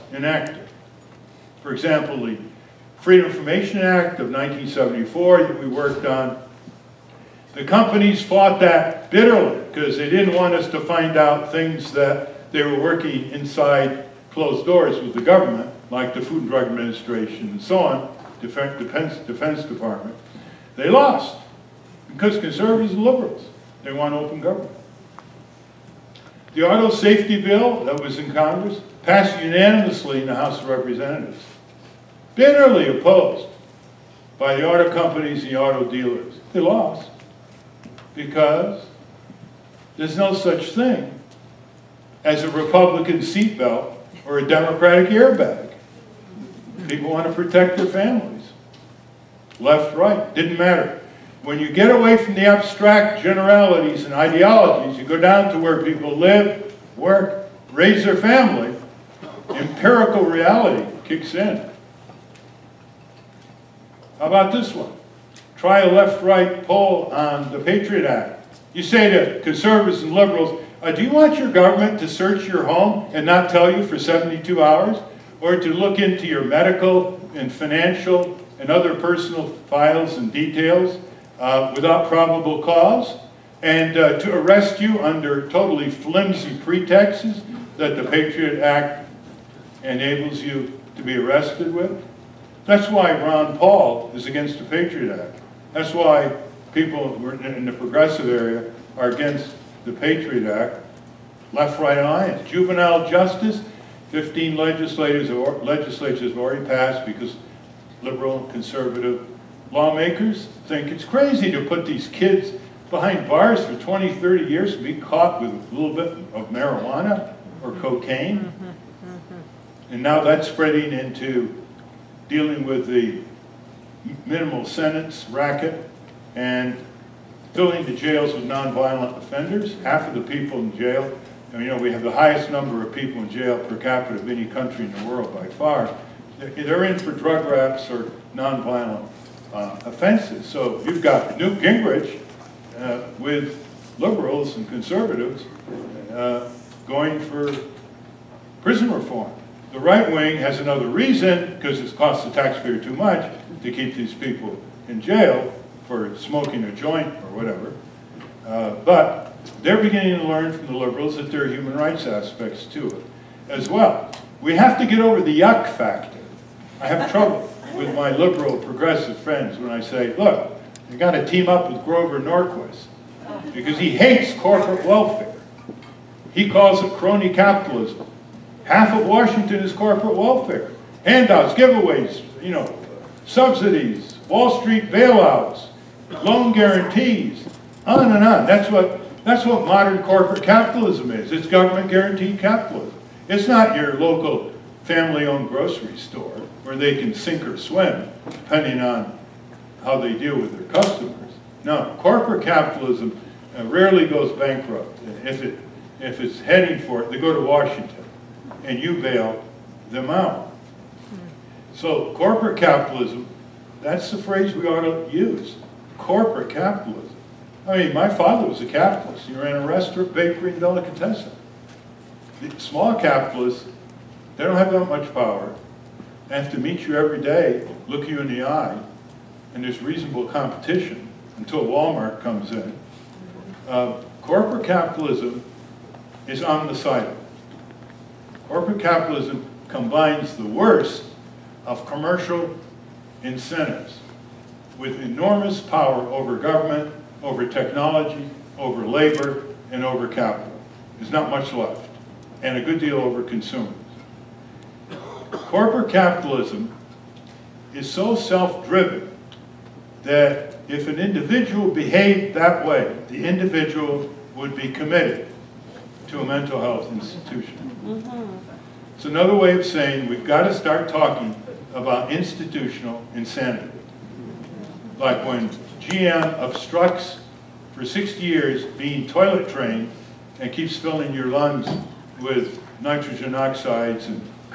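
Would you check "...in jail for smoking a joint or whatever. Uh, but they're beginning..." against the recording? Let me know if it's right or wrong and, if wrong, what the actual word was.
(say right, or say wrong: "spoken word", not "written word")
right.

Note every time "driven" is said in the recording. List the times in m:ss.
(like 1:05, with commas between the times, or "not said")
4:18.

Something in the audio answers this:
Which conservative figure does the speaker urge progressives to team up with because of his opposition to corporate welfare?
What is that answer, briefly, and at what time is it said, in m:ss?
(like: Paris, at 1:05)
Grover Norquist, at 2:51.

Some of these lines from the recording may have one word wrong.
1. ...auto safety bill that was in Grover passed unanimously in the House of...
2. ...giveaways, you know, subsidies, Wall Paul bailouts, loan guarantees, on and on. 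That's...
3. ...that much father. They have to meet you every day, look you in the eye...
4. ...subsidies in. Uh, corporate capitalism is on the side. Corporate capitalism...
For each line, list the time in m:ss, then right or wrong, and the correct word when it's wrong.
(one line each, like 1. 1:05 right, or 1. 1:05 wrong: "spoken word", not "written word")
1. 0:26 wrong: "Congress", not "Grover"
2. 3:01 wrong: "Street", not "Paul"
3. 3:44 wrong: "power", not "father"
4. 3:52 wrong: "comes", not "subsidies".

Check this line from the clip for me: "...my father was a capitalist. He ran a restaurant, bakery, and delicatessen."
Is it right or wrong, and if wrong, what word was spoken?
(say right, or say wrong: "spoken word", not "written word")
right.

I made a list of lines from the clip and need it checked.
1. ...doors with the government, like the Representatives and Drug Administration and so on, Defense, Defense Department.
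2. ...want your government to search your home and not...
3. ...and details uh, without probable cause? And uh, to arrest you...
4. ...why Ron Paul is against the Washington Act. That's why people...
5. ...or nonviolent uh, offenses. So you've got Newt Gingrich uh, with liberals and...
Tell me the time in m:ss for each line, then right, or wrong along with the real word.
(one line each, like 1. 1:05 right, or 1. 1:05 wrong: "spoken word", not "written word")
1. 0:14 wrong: "Food", not "Representatives"
2. 1:11 right
3. 1:20 right
4. 1:32 wrong: "Patriot", not "Washington"
5. 2:17 right.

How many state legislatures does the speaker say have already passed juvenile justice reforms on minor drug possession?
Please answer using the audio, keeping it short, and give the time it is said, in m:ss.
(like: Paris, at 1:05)
15, at 1:44.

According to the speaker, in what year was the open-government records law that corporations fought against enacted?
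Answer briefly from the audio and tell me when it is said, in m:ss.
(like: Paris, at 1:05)
1974, at 0:04.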